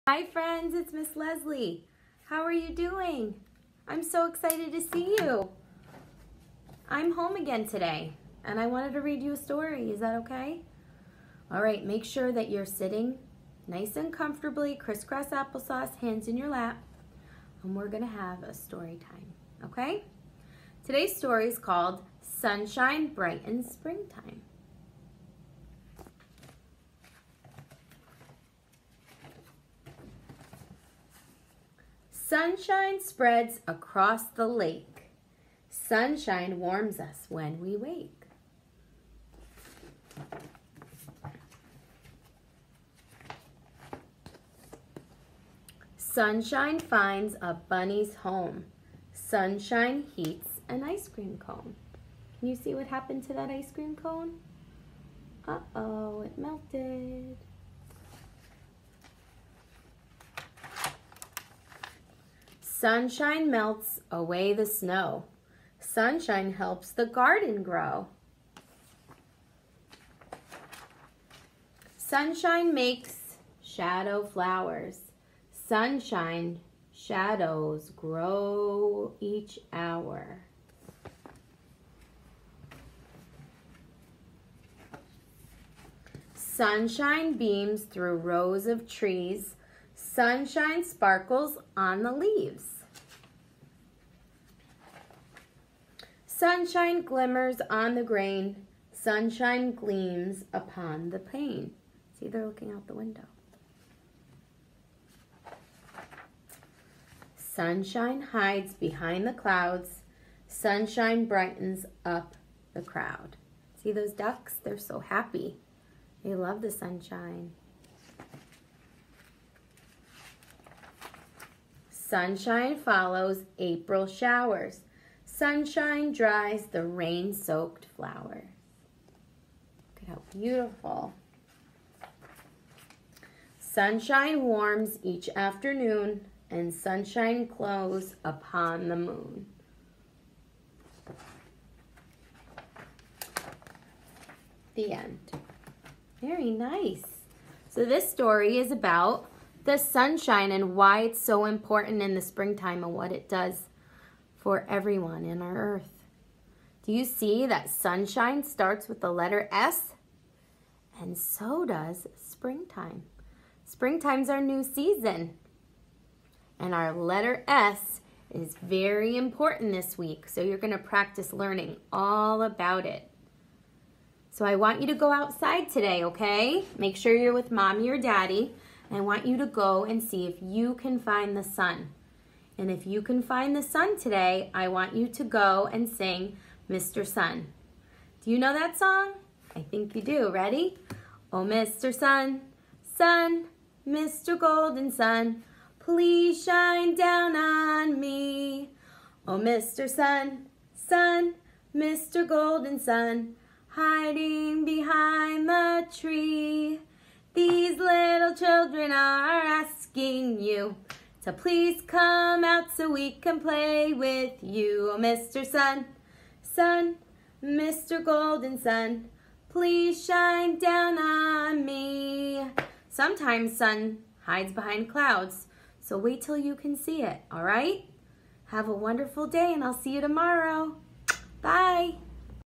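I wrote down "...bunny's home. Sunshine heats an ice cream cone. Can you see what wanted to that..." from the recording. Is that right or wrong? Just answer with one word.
wrong.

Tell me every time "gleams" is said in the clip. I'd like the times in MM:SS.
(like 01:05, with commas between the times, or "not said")
01:39.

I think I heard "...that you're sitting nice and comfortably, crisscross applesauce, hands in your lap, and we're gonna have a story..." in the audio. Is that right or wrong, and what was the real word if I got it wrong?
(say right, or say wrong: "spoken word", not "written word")
right.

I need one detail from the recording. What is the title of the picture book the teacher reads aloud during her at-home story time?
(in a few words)
Sunshine Brightens Springtime.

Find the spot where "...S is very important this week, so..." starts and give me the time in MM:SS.
02:47.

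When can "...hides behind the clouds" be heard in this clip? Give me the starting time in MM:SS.
01:48.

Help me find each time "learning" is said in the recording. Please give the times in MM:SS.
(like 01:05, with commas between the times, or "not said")
02:51.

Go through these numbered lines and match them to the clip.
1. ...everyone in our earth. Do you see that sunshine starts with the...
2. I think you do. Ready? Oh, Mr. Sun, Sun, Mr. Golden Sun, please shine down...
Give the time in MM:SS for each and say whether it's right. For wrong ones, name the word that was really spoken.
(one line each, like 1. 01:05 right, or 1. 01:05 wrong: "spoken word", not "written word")
1. 02:34 right
2. 03:09 right.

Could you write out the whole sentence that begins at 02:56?
Make sure you're with mommy or daddy.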